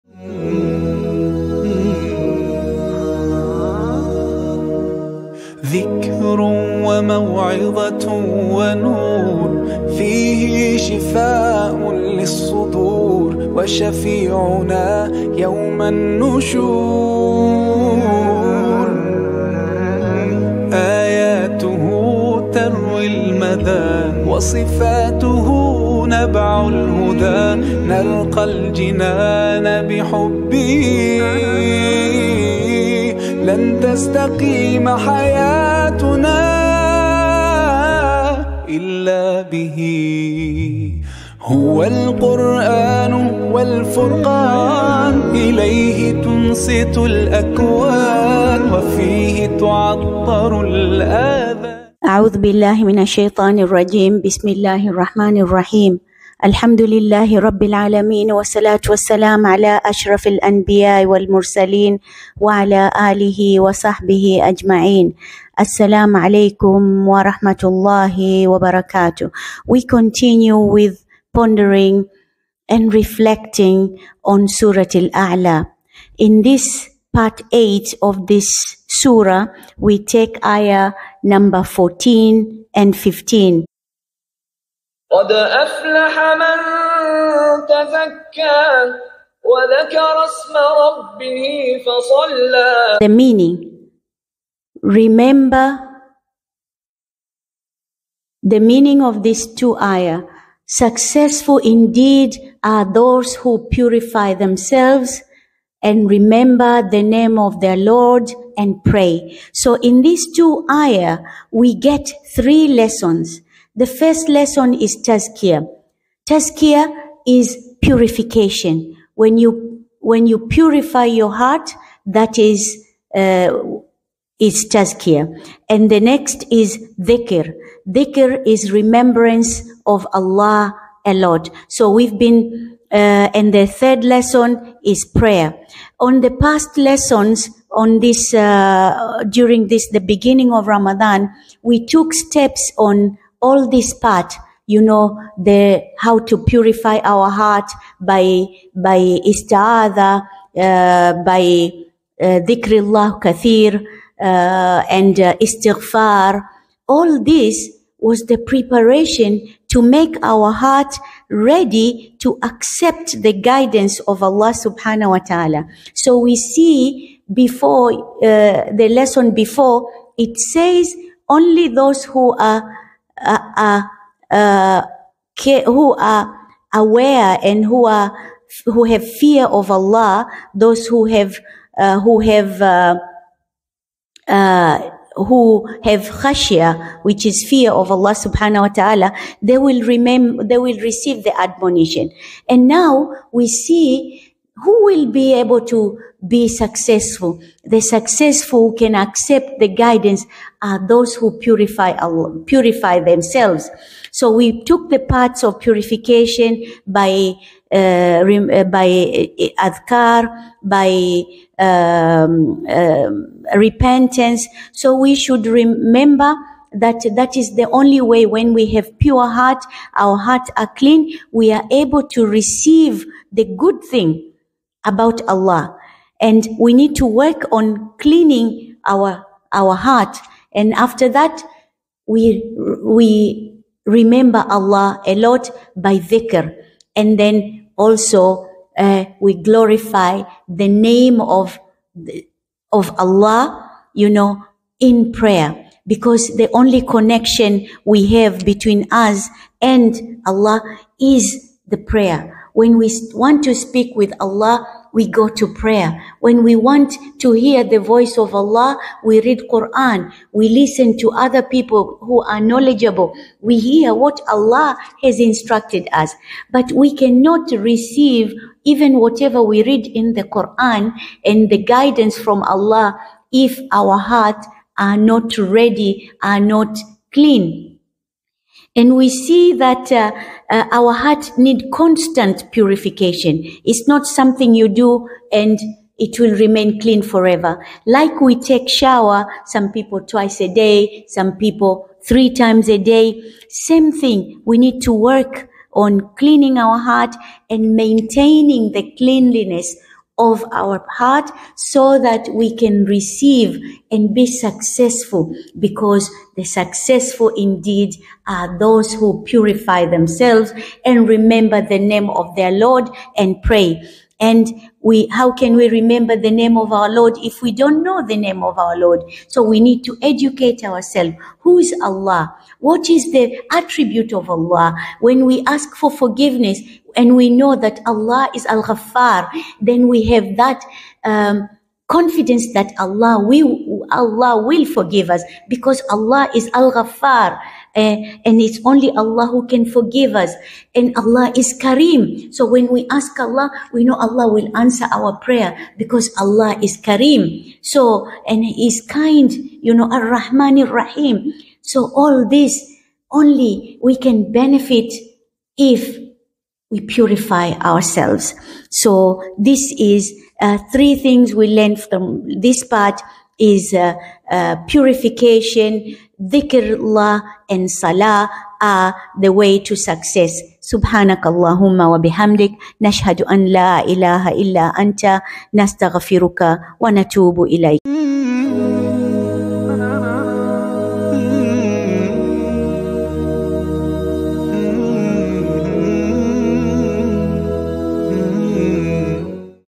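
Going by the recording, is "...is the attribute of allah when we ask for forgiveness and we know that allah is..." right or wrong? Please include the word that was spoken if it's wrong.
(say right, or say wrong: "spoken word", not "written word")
right.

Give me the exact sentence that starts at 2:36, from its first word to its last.
All this was the preparation to make our heart ready to accept the guidance of Allah subhanahu wa ta'ala.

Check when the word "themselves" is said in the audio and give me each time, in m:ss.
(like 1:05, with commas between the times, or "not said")
1:44, 3:22, 5:09.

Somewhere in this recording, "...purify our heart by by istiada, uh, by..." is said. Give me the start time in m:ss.
2:26.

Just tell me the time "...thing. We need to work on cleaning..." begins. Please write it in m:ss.
4:53.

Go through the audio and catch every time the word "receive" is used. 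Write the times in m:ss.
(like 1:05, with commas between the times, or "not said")
3:10, 3:42, 4:27, 5:02.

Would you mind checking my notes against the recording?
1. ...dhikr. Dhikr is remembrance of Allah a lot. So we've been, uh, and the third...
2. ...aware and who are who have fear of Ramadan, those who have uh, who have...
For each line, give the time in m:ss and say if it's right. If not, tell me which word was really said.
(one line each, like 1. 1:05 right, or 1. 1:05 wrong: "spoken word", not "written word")
1. 2:06 right
2. 2:56 wrong: "Allah", not "Ramadan".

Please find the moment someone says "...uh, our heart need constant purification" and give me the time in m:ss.
4:40.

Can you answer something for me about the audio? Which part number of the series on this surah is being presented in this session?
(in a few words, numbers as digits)
8.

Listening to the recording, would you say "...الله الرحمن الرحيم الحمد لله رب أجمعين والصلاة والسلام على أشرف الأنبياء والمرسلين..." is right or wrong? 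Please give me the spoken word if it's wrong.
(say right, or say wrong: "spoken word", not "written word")
wrong: "العالمين", not "أجمعين".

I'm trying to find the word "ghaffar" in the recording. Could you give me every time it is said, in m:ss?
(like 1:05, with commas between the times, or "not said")
5:28, 5:36.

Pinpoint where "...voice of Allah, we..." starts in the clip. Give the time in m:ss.
4:17.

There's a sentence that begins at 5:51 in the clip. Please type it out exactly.
So all this only we can benefit if we purify ourselves.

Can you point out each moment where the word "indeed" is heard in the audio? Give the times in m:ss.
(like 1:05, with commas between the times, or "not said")
1:41, 5:07.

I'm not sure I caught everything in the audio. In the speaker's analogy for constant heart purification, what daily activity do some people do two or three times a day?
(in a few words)
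take shower.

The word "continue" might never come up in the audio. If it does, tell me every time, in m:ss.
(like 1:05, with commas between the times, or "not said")
1:09.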